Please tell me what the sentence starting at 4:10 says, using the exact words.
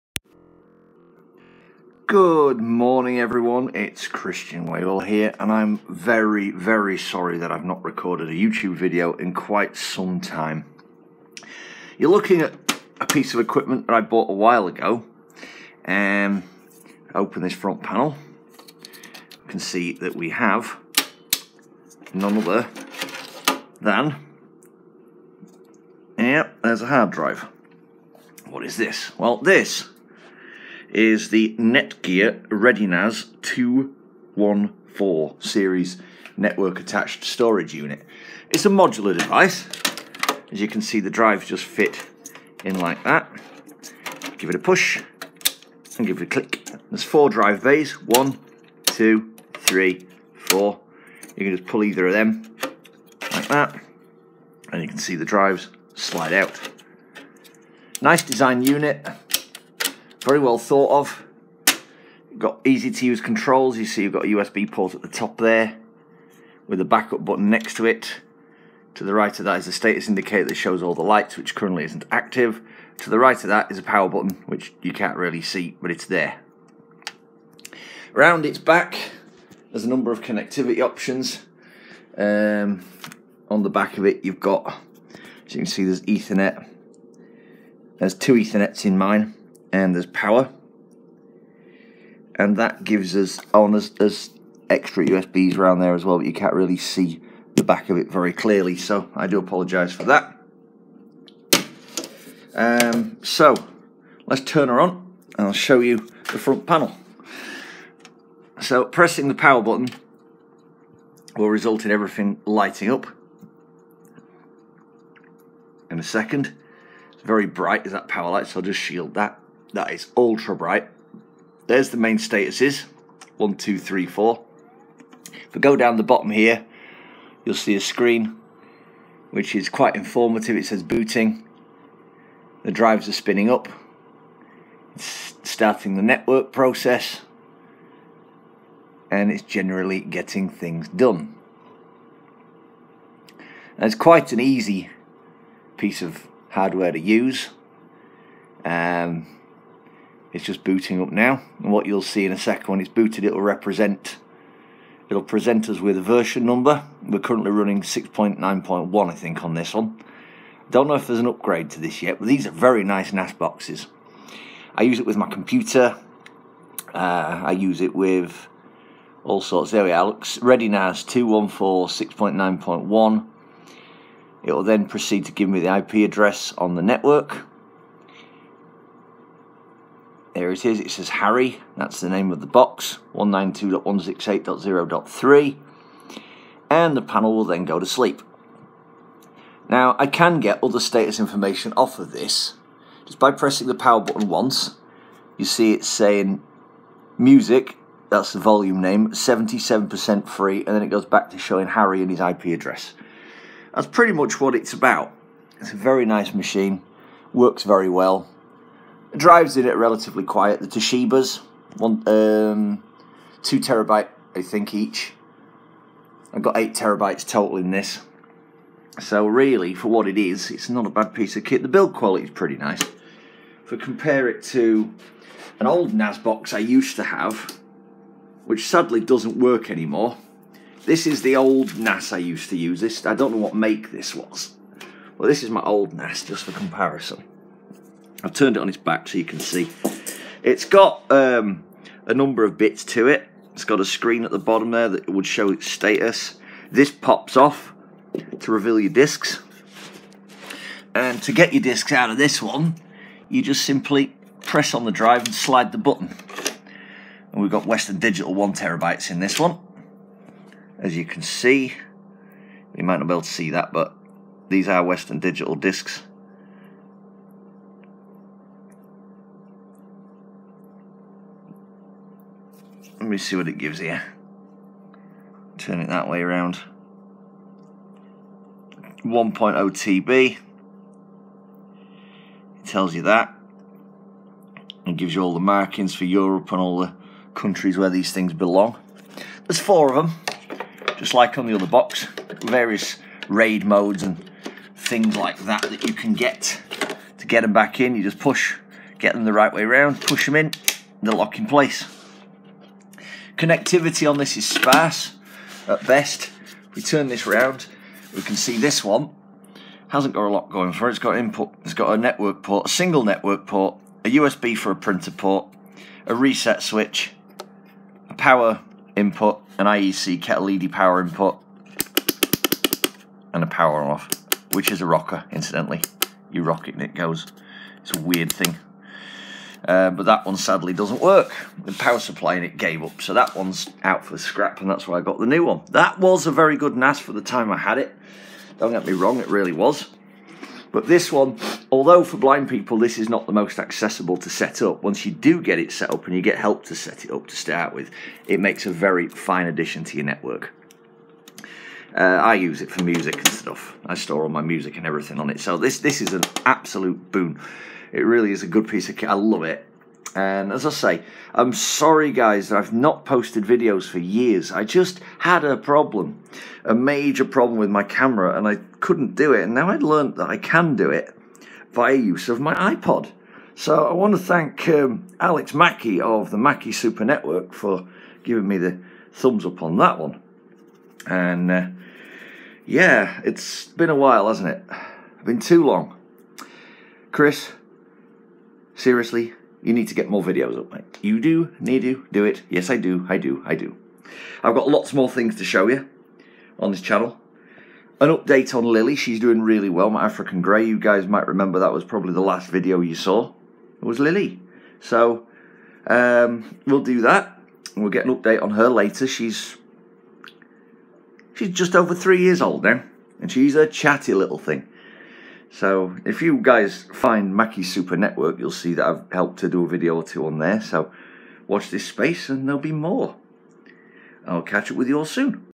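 And to get your discs out of this one, you just simply press on the drive and slide the button.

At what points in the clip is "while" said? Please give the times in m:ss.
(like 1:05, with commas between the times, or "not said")
0:14, 6:23.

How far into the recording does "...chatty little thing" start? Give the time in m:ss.
6:53.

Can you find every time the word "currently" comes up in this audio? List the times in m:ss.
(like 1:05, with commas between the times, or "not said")
1:11, 2:37.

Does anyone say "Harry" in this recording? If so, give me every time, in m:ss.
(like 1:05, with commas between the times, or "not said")
3:01, 3:21.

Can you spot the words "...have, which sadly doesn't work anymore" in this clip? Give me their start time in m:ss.
3:47.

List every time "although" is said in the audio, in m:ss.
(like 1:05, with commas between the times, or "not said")
5:41.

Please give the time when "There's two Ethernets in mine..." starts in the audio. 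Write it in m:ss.
1:27.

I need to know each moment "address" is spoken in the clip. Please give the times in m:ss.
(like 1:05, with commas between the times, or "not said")
2:56, 3:22.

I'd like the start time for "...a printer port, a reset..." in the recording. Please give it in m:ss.
5:14.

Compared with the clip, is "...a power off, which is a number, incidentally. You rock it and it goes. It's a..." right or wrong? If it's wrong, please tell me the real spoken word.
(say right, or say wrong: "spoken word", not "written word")
wrong: "rocker", not "number".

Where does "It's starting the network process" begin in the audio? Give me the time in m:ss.
2:14.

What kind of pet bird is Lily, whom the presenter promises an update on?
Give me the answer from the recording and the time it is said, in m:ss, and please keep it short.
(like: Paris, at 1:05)
African Grey, at 6:40.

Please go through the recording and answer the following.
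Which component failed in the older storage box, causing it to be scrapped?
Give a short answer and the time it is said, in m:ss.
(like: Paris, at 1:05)
The power supply, at 5:31.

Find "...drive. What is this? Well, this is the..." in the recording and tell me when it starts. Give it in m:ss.
0:27.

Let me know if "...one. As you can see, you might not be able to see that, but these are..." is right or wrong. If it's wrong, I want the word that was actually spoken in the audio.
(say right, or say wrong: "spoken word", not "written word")
right.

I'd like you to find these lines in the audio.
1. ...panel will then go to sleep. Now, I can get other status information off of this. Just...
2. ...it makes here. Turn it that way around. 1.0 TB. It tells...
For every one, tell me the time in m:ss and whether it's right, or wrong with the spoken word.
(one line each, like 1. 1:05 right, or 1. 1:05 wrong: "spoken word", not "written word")
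1. 3:07 right
2. 4:33 wrong: "gives", not "makes".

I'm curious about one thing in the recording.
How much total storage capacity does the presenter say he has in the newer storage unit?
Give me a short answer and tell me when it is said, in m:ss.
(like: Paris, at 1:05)
8 terabytes, at 3:36.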